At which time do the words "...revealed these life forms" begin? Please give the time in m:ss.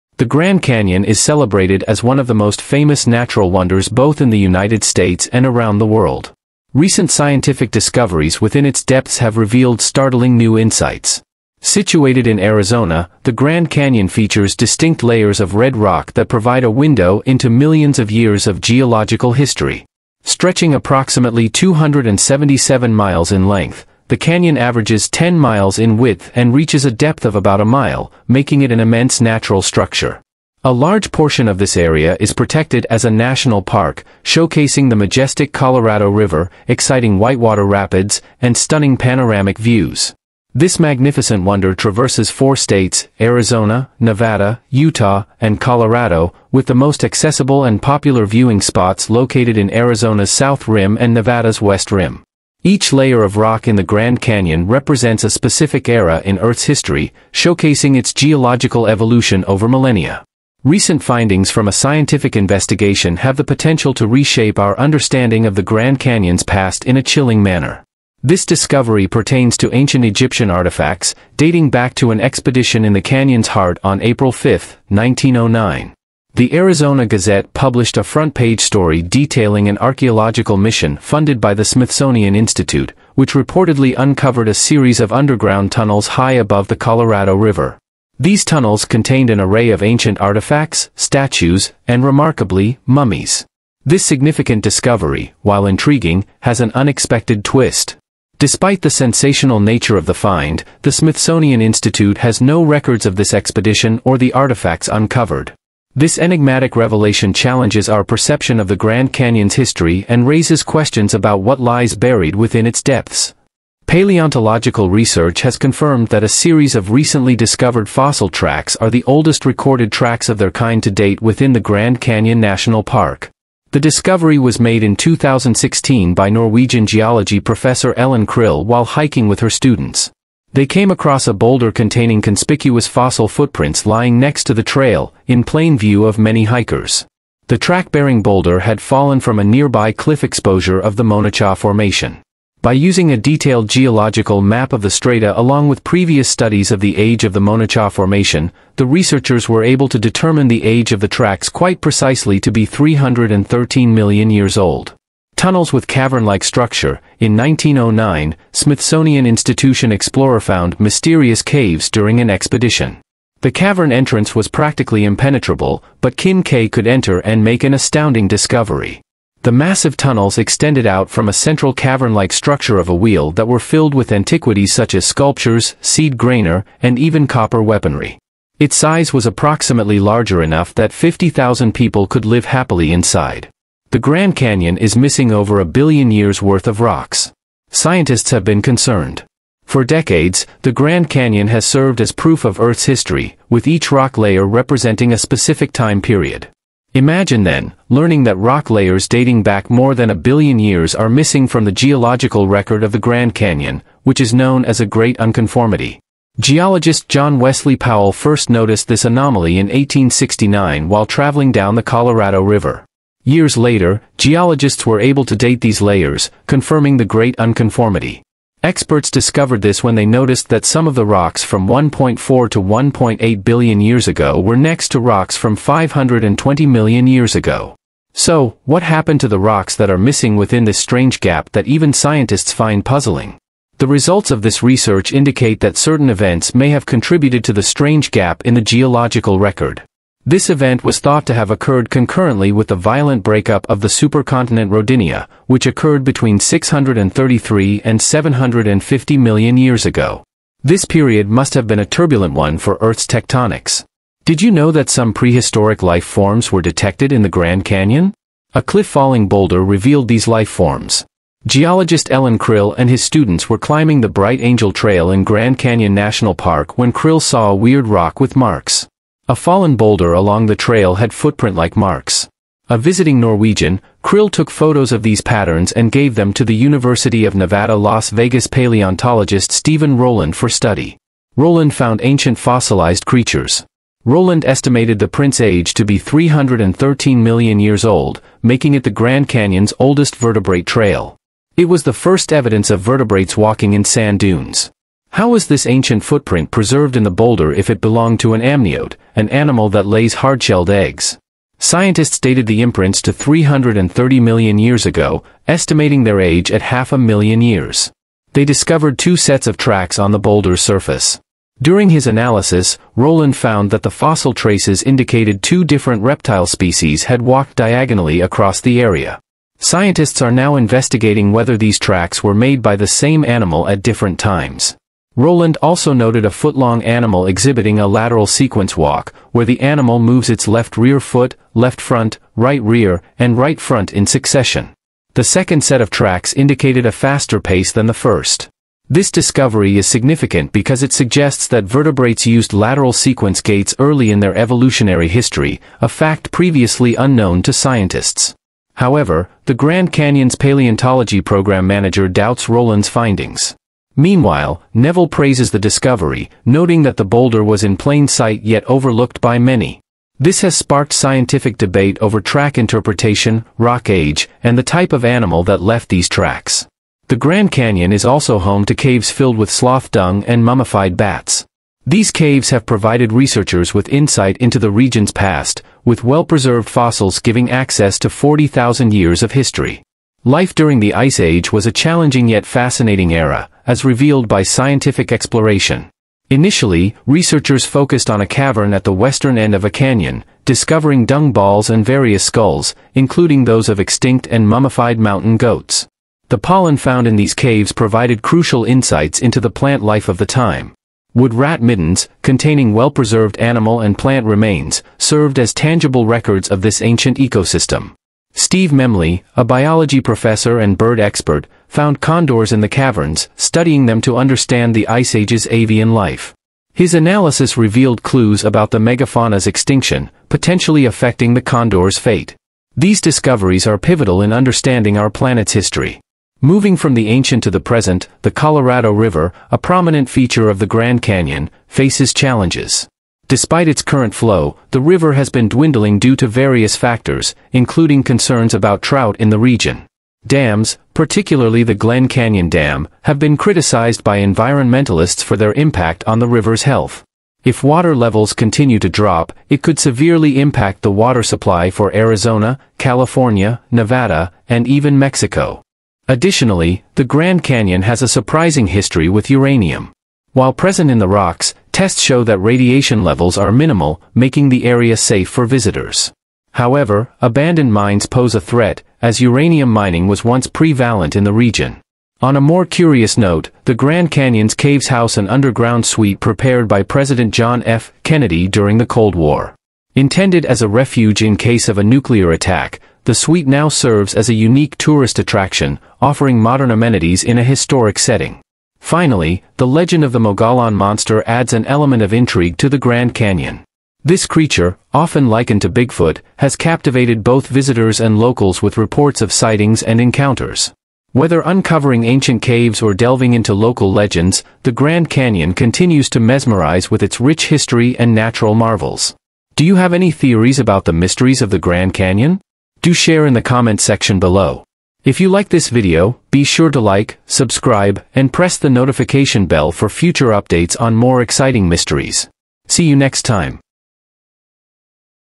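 4:19.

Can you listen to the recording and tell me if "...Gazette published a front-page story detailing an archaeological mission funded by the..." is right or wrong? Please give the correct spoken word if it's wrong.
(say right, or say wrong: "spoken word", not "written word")
right.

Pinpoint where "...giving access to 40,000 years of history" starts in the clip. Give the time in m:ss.
6:17.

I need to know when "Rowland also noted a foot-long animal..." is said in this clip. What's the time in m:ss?
5:25.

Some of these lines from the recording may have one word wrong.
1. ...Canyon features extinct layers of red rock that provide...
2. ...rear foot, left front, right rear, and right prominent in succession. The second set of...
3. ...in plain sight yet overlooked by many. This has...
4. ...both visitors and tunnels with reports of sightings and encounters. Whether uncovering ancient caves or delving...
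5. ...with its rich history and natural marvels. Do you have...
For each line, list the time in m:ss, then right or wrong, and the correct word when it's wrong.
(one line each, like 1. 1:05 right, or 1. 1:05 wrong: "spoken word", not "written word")
1. 0:13 wrong: "distinct", not "extinct"
2. 5:30 wrong: "front", not "prominent"
3. 5:57 right
4. 8:17 wrong: "locals", not "tunnels"
5. 8:26 right.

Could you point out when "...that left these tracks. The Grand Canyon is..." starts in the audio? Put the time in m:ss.
6:05.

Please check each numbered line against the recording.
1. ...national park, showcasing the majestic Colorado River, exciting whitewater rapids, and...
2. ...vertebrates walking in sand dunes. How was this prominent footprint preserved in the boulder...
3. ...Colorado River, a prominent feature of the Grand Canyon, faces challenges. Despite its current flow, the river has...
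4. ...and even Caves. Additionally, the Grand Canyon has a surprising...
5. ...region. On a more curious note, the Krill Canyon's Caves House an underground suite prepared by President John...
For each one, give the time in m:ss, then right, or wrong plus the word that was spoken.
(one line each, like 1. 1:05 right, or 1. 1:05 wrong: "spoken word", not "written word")
1. 0:33 right
2. 4:52 wrong: "ancient", not "prominent"
3. 7:08 right
4. 7:34 wrong: "Mexico", not "Caves"
5. 7:51 wrong: "Grand", not "Krill".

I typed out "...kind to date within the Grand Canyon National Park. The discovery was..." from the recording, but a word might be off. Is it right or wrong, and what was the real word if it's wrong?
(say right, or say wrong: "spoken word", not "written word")
right.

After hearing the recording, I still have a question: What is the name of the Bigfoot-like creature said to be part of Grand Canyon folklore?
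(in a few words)
Mogollon monster.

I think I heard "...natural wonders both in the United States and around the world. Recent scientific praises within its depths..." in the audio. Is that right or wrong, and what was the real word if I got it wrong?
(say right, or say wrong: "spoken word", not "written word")
wrong: "discoveries", not "praises".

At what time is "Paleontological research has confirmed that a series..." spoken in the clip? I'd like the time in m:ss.
1:53.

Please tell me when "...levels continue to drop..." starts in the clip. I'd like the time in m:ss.
7:27.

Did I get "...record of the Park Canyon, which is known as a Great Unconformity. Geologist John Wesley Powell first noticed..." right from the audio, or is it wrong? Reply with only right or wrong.
wrong.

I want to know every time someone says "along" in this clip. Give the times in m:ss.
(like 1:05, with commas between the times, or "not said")
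2:25, 4:30.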